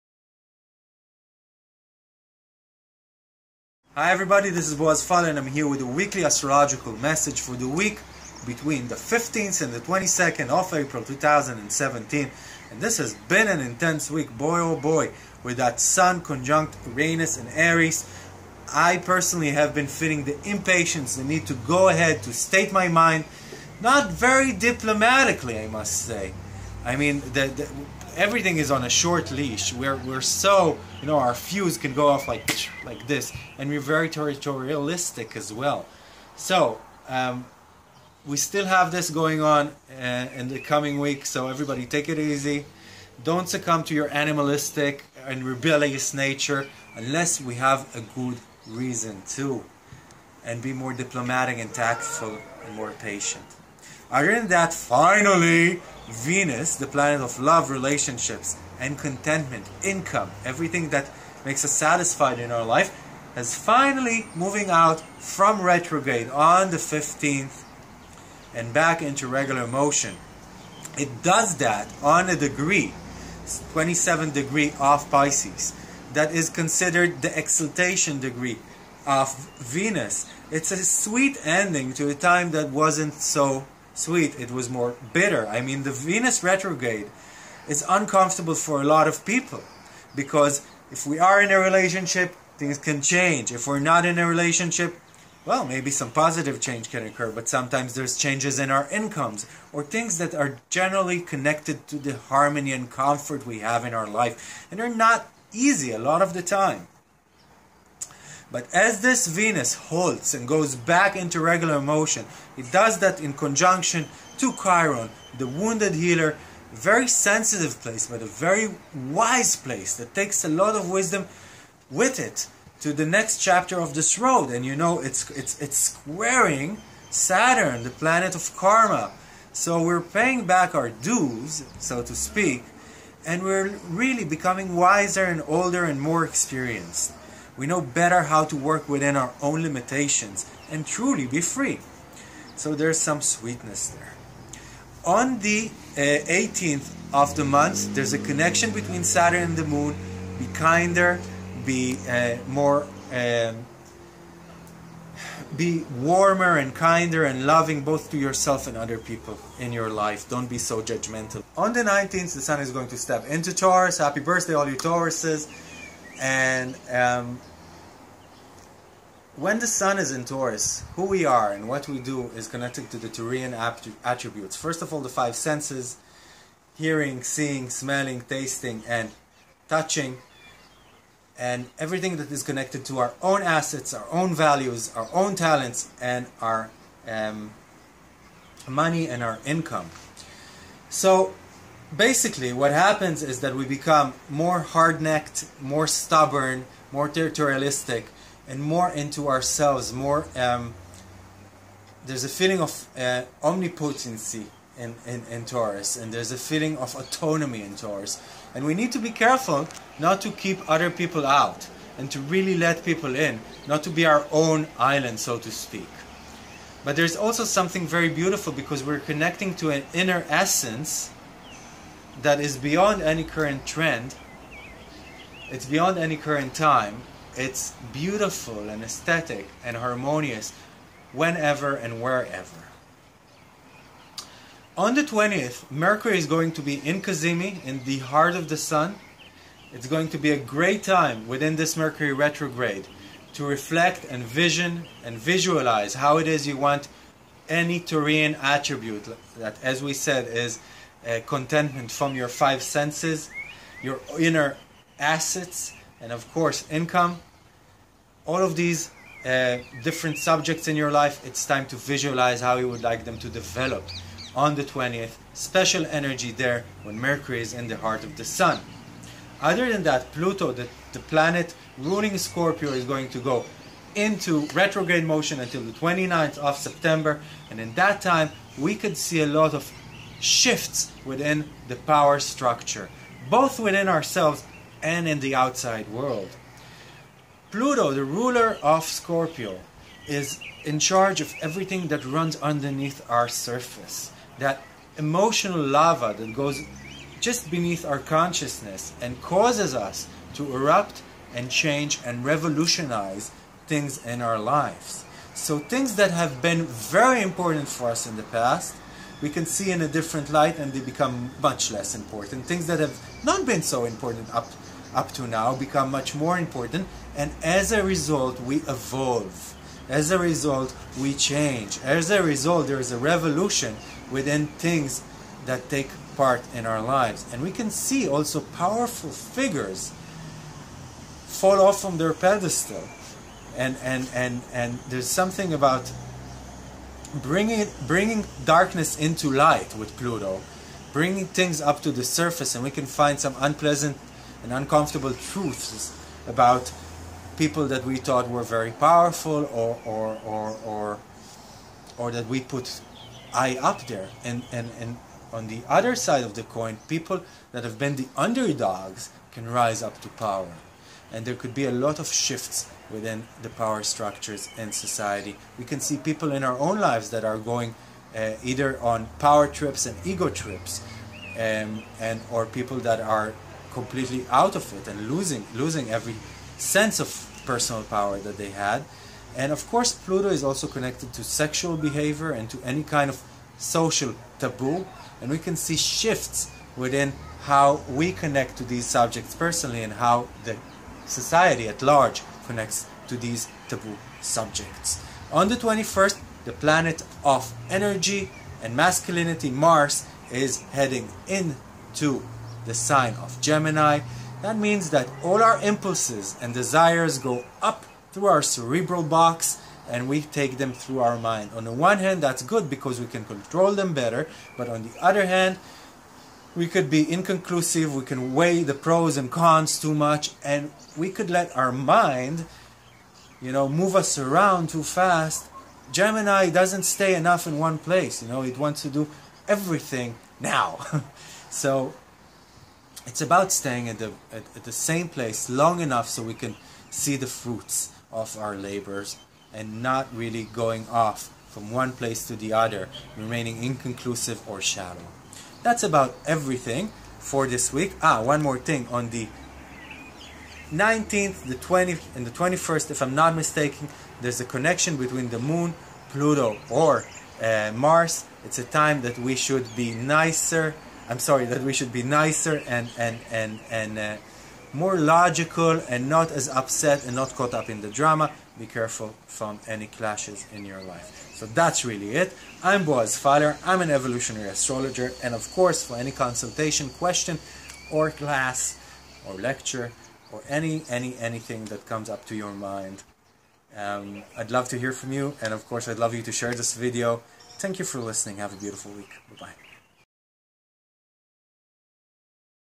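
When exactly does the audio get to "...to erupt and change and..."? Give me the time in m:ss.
5:00.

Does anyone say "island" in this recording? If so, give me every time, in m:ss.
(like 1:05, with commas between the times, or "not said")
3:34.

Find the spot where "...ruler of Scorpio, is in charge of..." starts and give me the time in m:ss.
4:48.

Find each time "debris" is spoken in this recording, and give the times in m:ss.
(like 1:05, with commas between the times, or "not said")
not said.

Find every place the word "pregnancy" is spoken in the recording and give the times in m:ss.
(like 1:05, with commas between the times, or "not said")
not said.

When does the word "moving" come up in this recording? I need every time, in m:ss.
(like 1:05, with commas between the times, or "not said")
1:04.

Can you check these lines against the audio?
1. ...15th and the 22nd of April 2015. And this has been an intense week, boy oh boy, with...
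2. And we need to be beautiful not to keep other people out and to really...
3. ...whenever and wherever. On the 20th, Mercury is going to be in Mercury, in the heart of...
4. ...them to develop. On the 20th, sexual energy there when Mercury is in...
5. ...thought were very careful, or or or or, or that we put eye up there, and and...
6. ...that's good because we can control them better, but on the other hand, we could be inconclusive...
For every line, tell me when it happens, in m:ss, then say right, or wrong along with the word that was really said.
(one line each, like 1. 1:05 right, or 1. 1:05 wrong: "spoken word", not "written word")
1. 0:08 wrong: "2017", not "2015"
2. 3:28 wrong: "careful", not "beautiful"
3. 3:51 wrong: "Cazimi", not "Mercury"
4. 4:23 wrong: "special", not "sexual"
5. 5:47 wrong: "powerful", not "careful"
6. 6:52 right.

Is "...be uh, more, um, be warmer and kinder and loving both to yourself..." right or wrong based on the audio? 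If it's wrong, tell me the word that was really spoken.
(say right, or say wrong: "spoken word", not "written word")
right.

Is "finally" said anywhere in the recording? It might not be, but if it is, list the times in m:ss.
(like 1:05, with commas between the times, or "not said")
0:54, 1:03.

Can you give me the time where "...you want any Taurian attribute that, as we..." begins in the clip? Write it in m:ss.
4:06.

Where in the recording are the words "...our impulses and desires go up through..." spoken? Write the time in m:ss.
6:45.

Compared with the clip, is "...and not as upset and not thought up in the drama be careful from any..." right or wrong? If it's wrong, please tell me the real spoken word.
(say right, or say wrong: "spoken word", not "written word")
wrong: "caught", not "thought".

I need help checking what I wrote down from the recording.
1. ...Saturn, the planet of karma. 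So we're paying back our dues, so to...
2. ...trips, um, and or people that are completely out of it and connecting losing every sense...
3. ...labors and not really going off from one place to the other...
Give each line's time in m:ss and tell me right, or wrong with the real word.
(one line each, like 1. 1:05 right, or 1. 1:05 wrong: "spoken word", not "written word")
1. 2:07 right
2. 6:10 wrong: "losing", not "connecting"
3. 7:18 right.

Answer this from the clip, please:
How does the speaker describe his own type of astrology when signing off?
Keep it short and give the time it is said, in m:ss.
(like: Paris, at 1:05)
evolutionary astrologer, at 7:53.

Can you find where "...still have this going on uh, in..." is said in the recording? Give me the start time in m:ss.
0:38.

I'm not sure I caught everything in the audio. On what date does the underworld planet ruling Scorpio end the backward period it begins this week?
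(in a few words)
29th of September.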